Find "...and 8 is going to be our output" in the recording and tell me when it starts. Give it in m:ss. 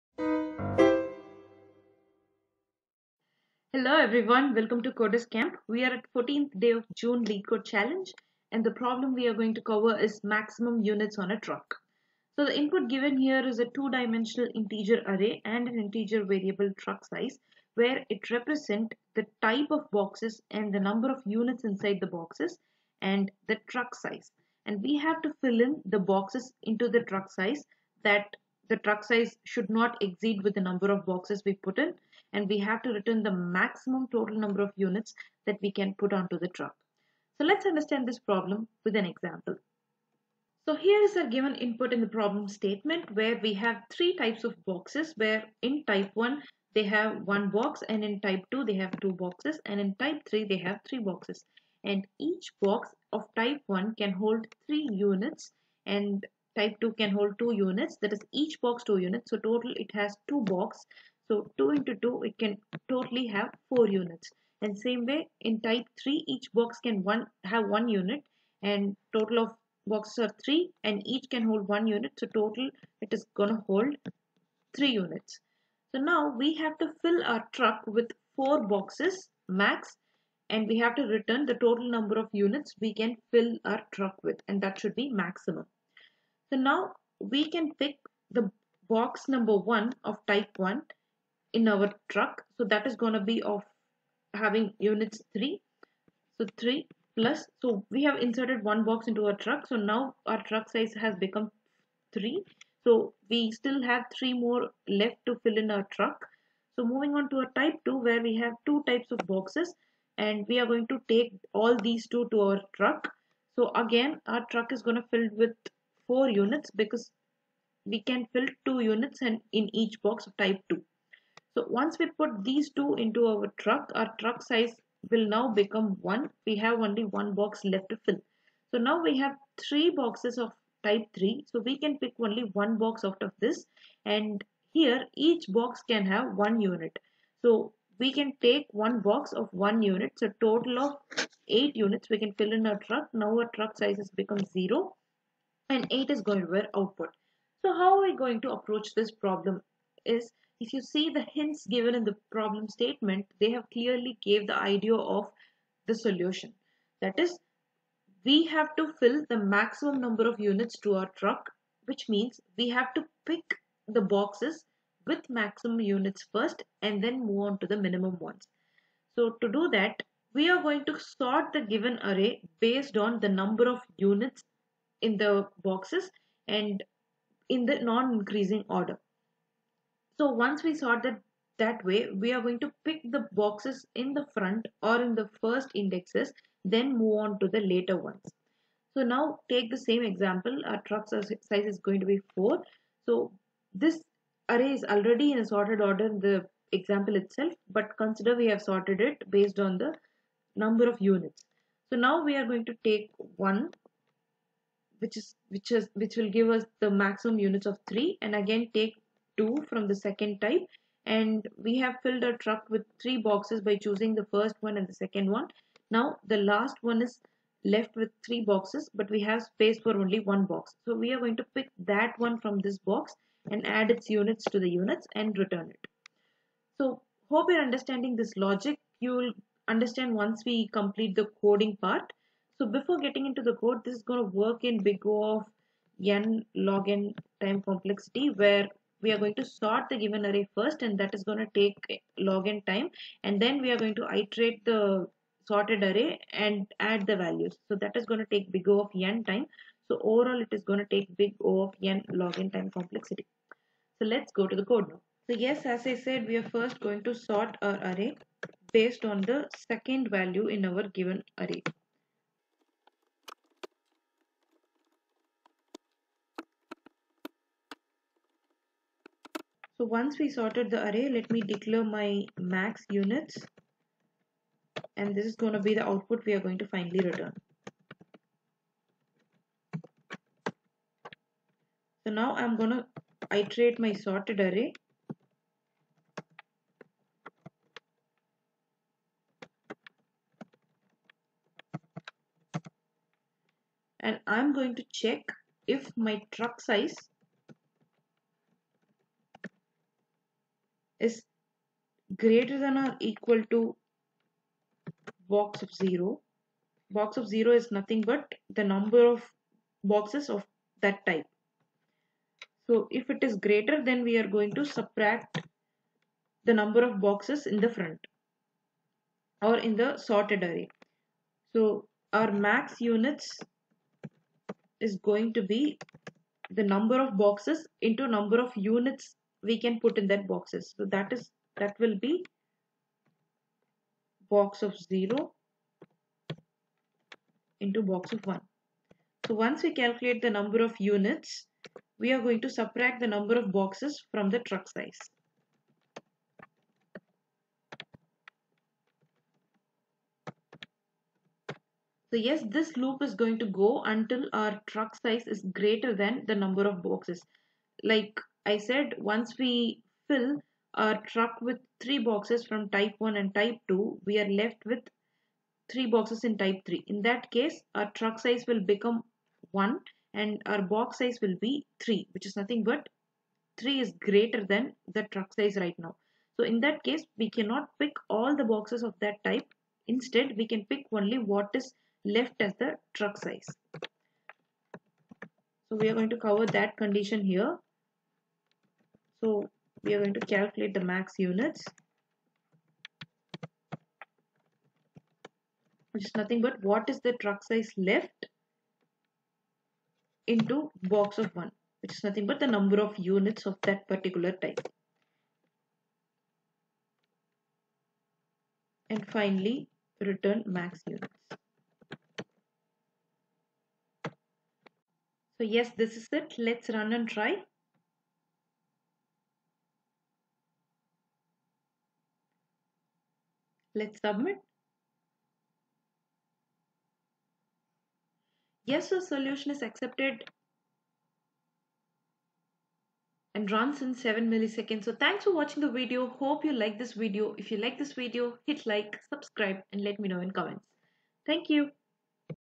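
2:25.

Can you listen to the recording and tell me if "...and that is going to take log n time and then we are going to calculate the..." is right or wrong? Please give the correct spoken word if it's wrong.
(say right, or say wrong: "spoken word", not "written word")
wrong: "iterate", not "calculate".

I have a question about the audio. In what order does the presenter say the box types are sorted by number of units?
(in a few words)
non-increasing order.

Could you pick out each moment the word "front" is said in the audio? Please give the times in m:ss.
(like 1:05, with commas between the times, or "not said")
3:04, 5:17.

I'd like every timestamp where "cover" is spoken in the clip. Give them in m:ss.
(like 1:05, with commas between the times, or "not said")
0:09, 6:26.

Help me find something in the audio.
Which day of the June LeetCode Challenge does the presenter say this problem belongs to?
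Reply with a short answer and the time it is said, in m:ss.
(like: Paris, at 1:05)
14th, at 0:06.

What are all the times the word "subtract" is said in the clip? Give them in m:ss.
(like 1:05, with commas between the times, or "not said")
5:14, 5:42.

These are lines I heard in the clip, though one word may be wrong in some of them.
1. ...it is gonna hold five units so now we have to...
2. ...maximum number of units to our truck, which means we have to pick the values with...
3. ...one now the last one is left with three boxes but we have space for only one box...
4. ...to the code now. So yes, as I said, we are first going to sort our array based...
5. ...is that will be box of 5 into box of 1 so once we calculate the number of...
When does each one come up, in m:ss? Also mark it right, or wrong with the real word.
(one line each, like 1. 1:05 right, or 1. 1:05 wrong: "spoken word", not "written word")
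1. 1:13 wrong: "three", not "five"
2. 2:39 wrong: "boxes", not "values"
3. 3:35 right
4. 4:14 right
5. 5:31 wrong: "0", not "5".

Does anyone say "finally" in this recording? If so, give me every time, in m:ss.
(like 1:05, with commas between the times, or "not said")
4:36, 6:49.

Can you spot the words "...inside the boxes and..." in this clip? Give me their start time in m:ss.
0:21.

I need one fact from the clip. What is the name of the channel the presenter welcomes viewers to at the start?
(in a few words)
Coders Camp.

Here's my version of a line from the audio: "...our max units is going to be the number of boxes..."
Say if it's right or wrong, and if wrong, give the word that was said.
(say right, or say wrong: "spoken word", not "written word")
right.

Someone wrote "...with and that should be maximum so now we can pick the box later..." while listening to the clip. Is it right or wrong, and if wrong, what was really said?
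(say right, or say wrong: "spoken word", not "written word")
wrong: "number", not "later".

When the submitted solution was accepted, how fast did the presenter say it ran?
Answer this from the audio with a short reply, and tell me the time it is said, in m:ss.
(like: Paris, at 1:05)
7 milliseconds, at 7:13.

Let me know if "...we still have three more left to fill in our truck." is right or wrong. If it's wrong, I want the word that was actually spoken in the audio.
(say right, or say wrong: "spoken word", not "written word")
right.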